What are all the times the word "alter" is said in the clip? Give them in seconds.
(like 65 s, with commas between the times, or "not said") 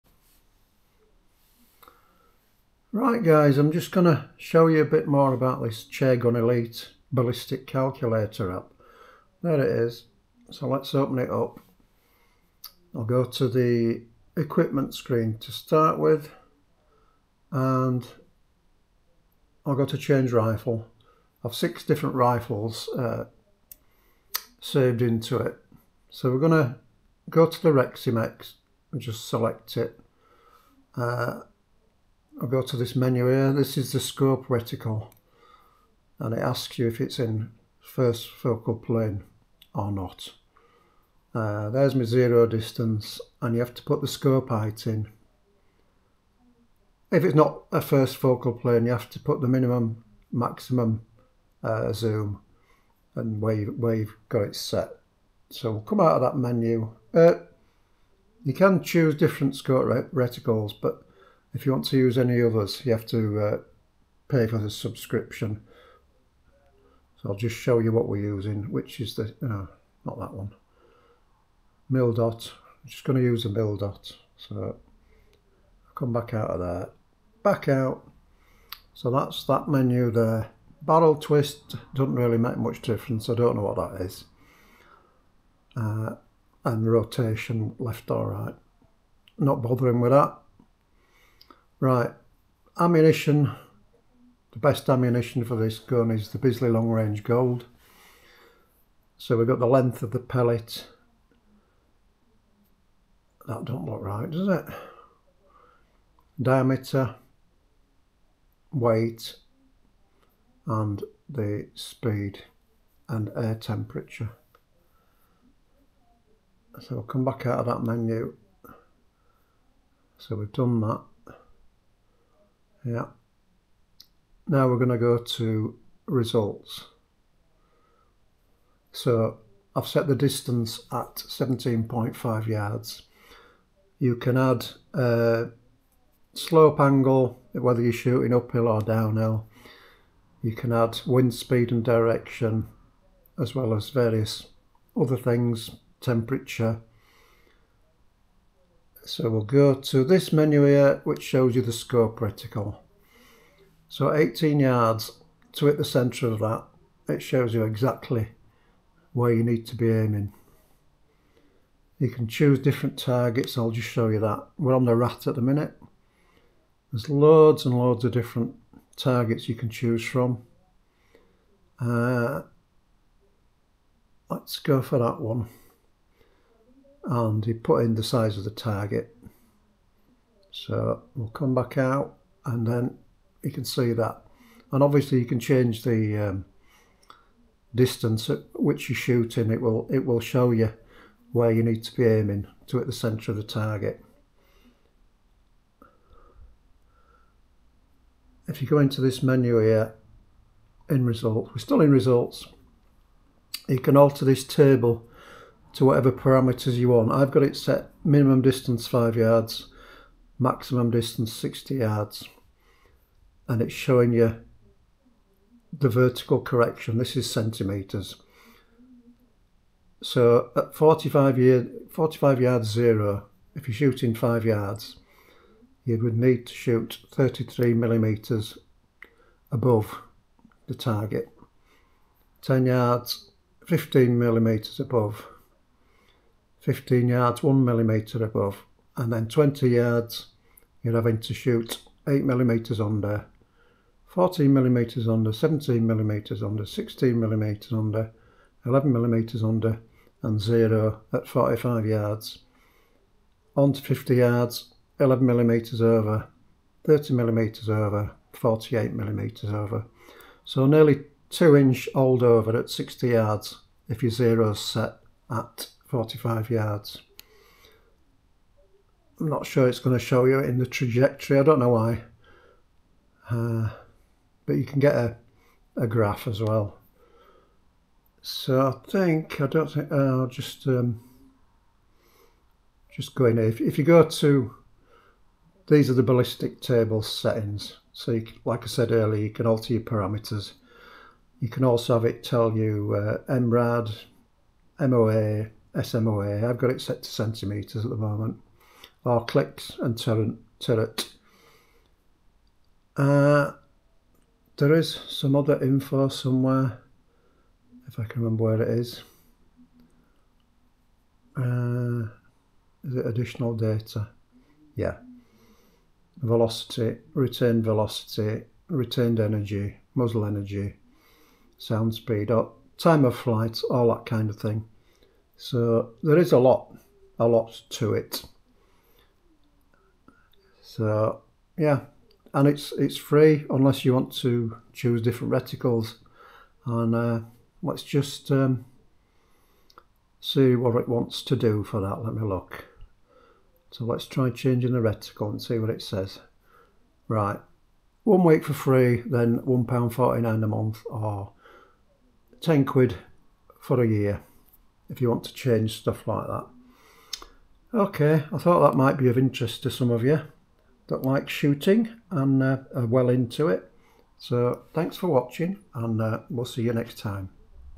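203 s, 289 s.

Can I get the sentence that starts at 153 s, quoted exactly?
So 18 yards to hit the center of that, it shows you exactly where you need to be aiming.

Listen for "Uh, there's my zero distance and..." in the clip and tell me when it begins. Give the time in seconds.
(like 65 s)
41 s.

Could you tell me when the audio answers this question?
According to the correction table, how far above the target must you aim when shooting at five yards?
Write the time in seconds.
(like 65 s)
227 s.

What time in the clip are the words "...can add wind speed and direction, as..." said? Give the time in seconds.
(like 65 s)
140 s.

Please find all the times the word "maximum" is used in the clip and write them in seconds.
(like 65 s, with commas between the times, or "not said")
50 s, 210 s.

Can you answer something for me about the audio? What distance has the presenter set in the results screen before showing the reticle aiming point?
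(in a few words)
17.5 yards.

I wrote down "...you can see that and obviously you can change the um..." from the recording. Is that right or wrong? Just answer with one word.
right.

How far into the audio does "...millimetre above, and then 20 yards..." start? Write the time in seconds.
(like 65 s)
237 s.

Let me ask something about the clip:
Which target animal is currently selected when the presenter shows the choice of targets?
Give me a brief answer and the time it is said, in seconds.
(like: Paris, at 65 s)
Rat, at 164 s.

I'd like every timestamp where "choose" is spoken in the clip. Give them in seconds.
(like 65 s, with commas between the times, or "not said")
58 s, 162 s, 169 s, 334 s.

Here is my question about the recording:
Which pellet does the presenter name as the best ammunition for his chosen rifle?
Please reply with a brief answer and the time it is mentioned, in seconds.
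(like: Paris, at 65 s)
Bisley Long Range Gold, at 96 s.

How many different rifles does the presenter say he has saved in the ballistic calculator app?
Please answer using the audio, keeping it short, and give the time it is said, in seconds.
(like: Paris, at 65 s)
6, at 21 s.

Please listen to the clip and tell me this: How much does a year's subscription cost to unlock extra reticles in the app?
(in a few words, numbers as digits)
10 quid.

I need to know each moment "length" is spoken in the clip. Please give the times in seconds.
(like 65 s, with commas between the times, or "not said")
99 s.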